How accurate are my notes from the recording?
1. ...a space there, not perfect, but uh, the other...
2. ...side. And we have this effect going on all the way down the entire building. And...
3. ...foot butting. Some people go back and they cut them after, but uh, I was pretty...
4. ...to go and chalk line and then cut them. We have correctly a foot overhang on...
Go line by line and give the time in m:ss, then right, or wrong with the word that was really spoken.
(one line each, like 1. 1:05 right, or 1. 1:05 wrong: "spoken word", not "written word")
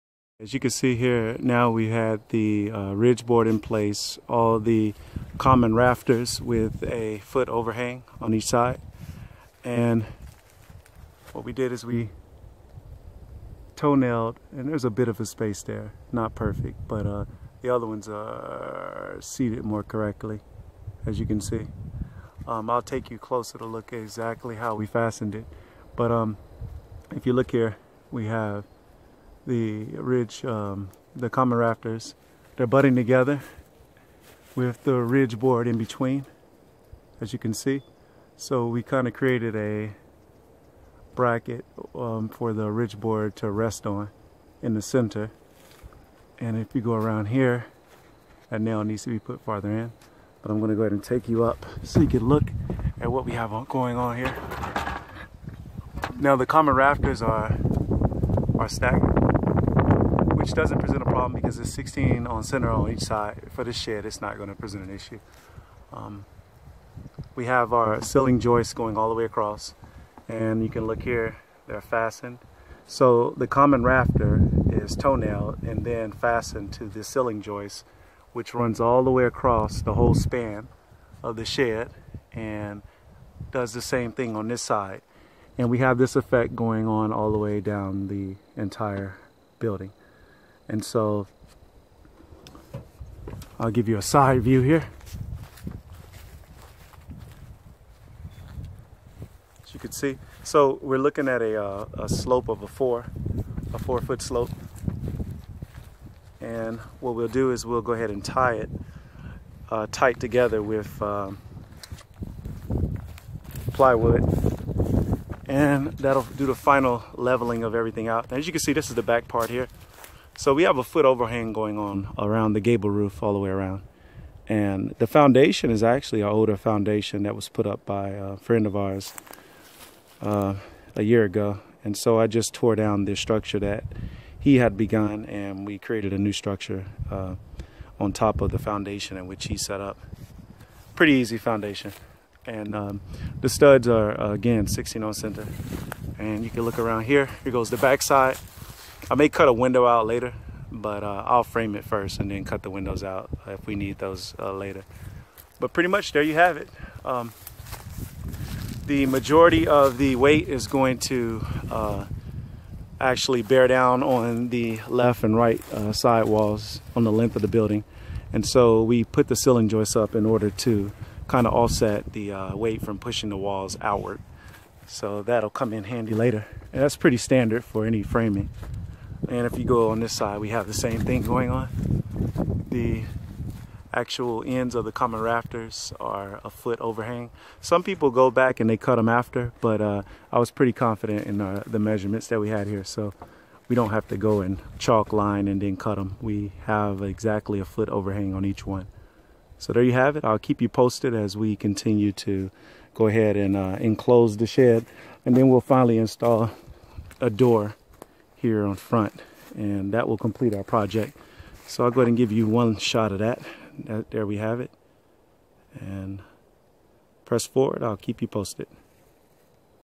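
1. 0:15 right
2. 1:24 right
3. 3:06 wrong: "overhang", not "butting"
4. 3:14 wrong: "exactly", not "correctly".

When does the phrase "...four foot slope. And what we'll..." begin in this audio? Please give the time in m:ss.
1:43.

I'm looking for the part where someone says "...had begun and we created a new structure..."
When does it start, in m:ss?
2:14.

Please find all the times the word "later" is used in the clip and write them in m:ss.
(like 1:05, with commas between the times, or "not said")
2:30, 2:34, 2:56.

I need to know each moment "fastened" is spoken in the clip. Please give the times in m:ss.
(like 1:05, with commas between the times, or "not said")
0:24, 1:11, 1:16.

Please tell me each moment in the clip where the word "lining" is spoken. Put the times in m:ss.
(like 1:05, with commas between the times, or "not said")
not said.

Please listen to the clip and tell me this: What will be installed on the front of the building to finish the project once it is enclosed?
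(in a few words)
a door.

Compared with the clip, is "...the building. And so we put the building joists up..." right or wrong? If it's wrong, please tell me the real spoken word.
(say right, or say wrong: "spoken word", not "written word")
wrong: "ceiling", not "building".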